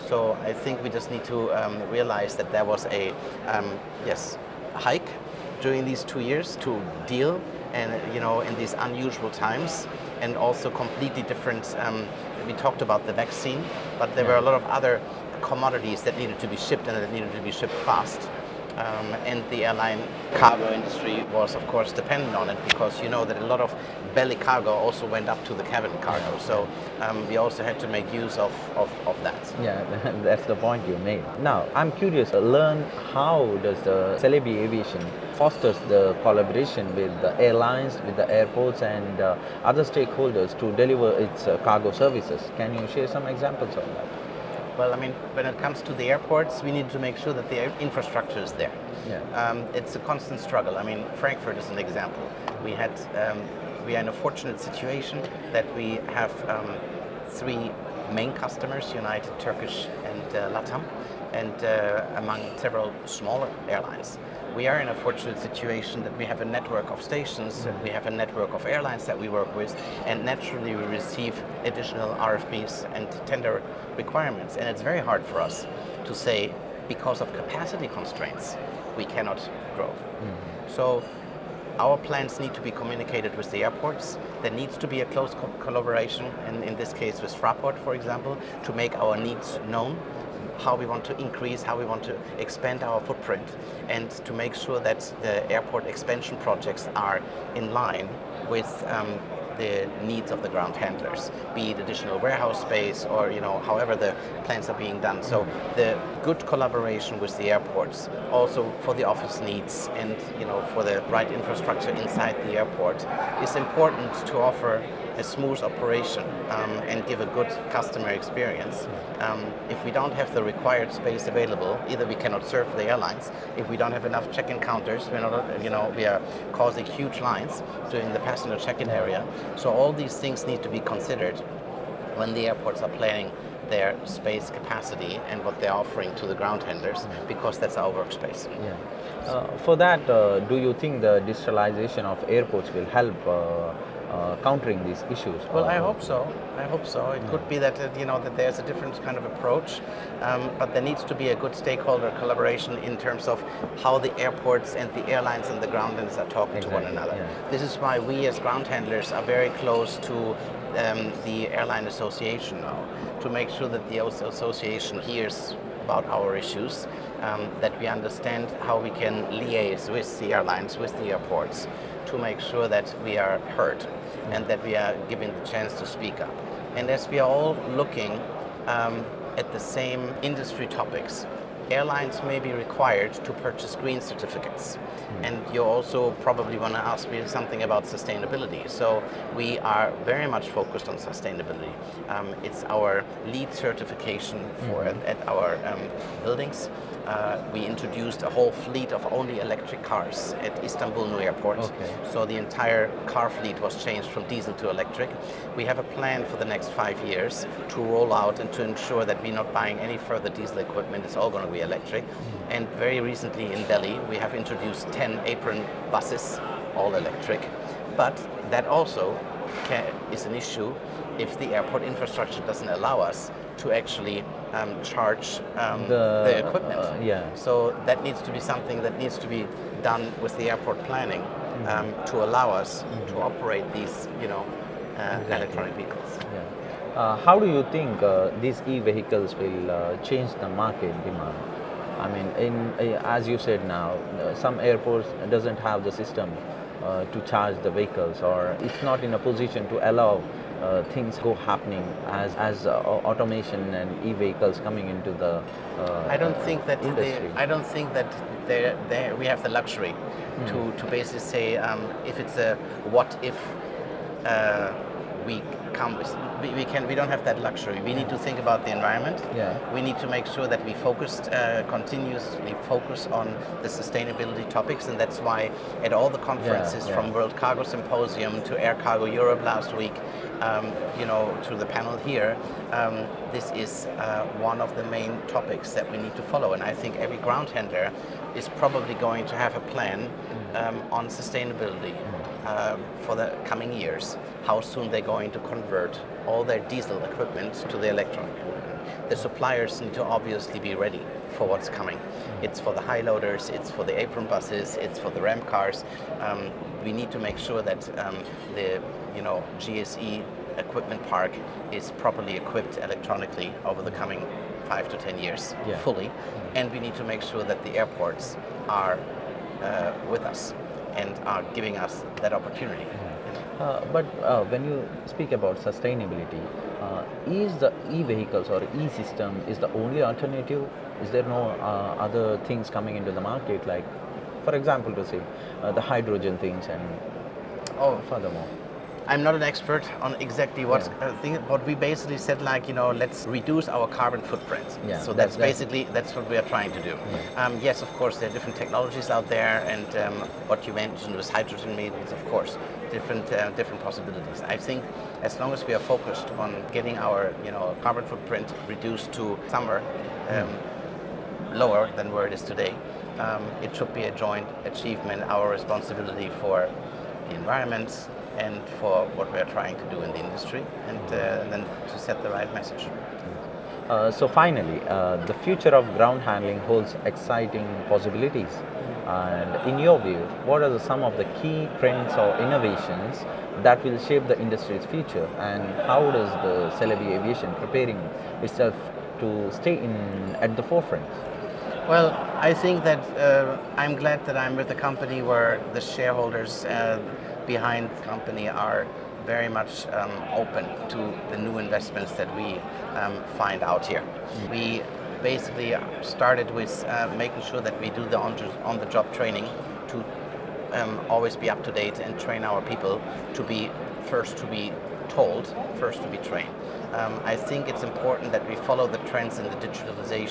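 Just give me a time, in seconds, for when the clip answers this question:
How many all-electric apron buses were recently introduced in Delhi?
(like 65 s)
214 s.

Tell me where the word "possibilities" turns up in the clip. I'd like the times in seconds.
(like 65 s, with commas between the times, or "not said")
353 s, 377 s.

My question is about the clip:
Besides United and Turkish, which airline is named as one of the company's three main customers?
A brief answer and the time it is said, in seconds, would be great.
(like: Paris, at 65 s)
Latam, at 60 s.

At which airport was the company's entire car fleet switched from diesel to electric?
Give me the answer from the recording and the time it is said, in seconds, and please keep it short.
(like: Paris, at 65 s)
Istanbul New Airport, at 200 s.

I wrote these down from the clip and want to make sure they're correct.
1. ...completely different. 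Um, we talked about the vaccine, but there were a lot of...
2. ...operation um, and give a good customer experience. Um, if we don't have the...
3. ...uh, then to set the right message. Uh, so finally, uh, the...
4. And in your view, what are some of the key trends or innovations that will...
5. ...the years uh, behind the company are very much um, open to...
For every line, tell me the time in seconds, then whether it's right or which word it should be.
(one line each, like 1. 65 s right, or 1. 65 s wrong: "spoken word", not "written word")
1. 10 s right
2. 115 s right
3. 371 s right
4. 379 s right
5. 395 s wrong: "shareholders", not "years".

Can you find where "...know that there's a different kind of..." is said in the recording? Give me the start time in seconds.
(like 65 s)
148 s.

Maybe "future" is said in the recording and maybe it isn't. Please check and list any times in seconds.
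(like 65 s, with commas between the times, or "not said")
375 s, 384 s.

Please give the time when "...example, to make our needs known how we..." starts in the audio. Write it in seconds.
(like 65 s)
87 s.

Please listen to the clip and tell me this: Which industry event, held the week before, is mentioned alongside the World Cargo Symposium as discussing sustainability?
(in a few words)
Air Cargo Europe.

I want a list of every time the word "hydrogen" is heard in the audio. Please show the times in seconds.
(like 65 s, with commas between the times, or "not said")
335 s, 351 s.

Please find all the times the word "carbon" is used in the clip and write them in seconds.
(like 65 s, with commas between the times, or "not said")
343 s, 357 s.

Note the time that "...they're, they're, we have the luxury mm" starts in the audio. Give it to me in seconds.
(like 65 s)
258 s.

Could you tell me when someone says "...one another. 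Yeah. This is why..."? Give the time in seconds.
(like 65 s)
156 s.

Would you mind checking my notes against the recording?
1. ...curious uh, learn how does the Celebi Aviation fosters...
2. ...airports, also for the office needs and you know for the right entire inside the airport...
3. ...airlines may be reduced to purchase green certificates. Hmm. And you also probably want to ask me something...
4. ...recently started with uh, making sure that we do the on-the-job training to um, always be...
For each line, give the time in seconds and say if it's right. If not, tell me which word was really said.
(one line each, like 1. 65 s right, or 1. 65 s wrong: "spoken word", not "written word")
1. 31 s right
2. 107 s wrong: "infrastructure", not "entire"
3. 181 s wrong: "required", not "reduced"
4. 405 s wrong: "basically", not "recently".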